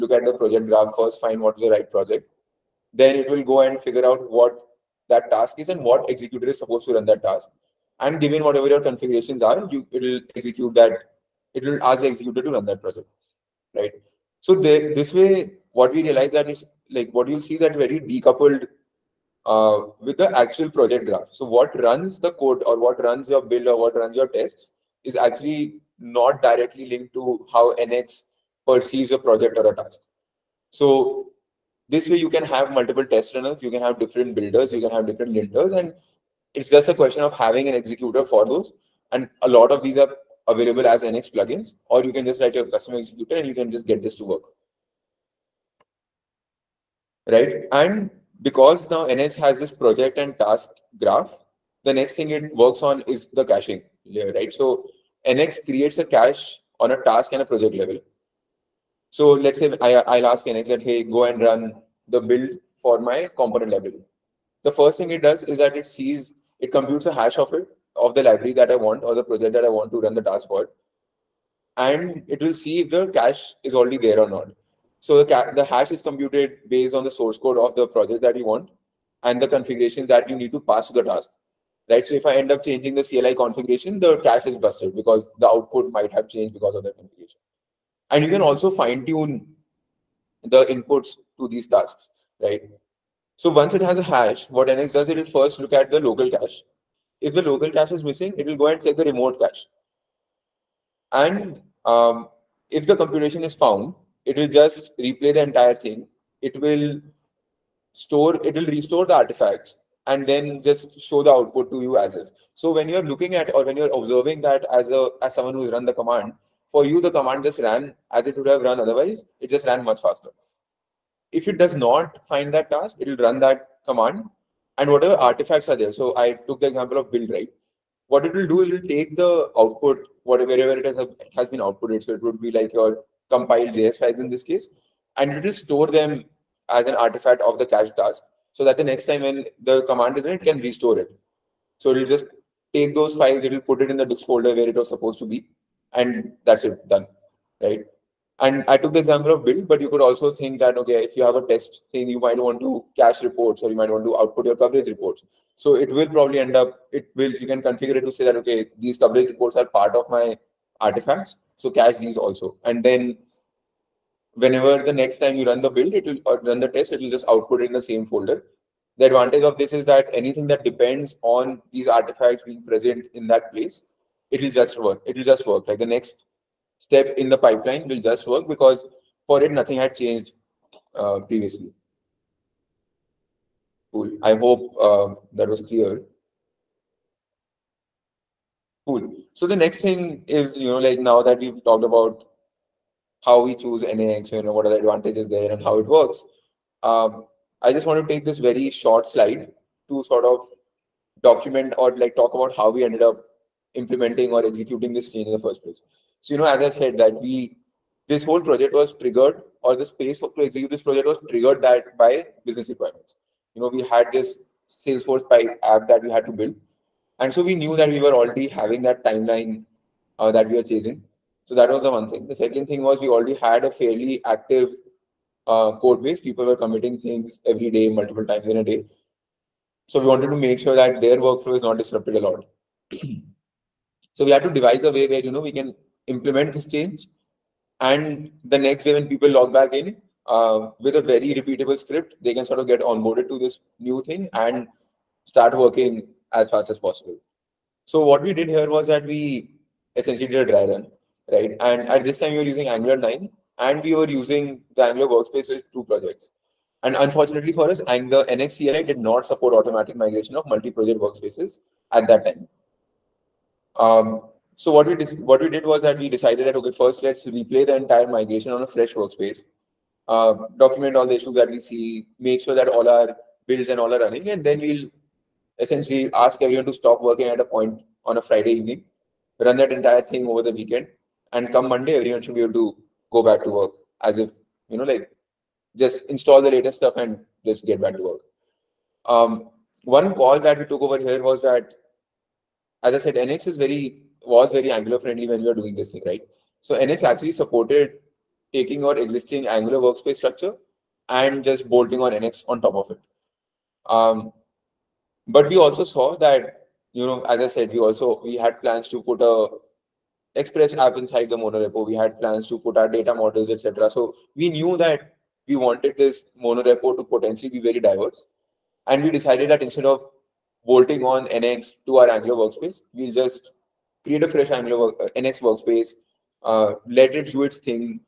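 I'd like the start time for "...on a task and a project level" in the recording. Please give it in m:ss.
0:56.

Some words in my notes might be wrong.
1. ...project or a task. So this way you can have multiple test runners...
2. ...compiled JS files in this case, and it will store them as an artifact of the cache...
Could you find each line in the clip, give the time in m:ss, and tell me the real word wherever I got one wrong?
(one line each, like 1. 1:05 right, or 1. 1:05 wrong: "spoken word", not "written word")
1. 0:29 right
2. 2:13 right.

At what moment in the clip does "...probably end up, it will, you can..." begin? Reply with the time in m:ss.
2:36.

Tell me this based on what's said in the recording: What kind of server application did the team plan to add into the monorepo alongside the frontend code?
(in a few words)
Express app.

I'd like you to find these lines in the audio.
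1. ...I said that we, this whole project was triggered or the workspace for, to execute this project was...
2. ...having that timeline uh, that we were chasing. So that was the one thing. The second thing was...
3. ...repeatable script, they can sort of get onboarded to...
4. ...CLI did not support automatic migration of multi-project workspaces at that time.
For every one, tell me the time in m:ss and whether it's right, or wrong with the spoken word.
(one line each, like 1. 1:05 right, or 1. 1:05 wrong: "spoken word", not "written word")
1. 3:26 wrong: "space", not "workspace"
2. 3:38 right
3. 4:01 right
4. 4:18 right.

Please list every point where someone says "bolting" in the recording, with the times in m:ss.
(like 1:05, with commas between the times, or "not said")
5:01, 5:20.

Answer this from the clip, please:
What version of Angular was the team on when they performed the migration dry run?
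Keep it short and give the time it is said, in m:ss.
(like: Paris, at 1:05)
Angular 9, at 4:12.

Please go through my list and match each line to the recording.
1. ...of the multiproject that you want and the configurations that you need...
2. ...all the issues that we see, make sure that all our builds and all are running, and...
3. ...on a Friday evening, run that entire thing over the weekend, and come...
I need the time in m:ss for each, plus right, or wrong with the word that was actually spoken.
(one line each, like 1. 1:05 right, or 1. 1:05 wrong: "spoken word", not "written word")
1. 1:17 wrong: "project", not "multiproject"
2. 4:30 right
3. 4:38 right.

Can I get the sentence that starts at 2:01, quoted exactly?
If it does not find that task, it will run that command and whatever artifacts are there.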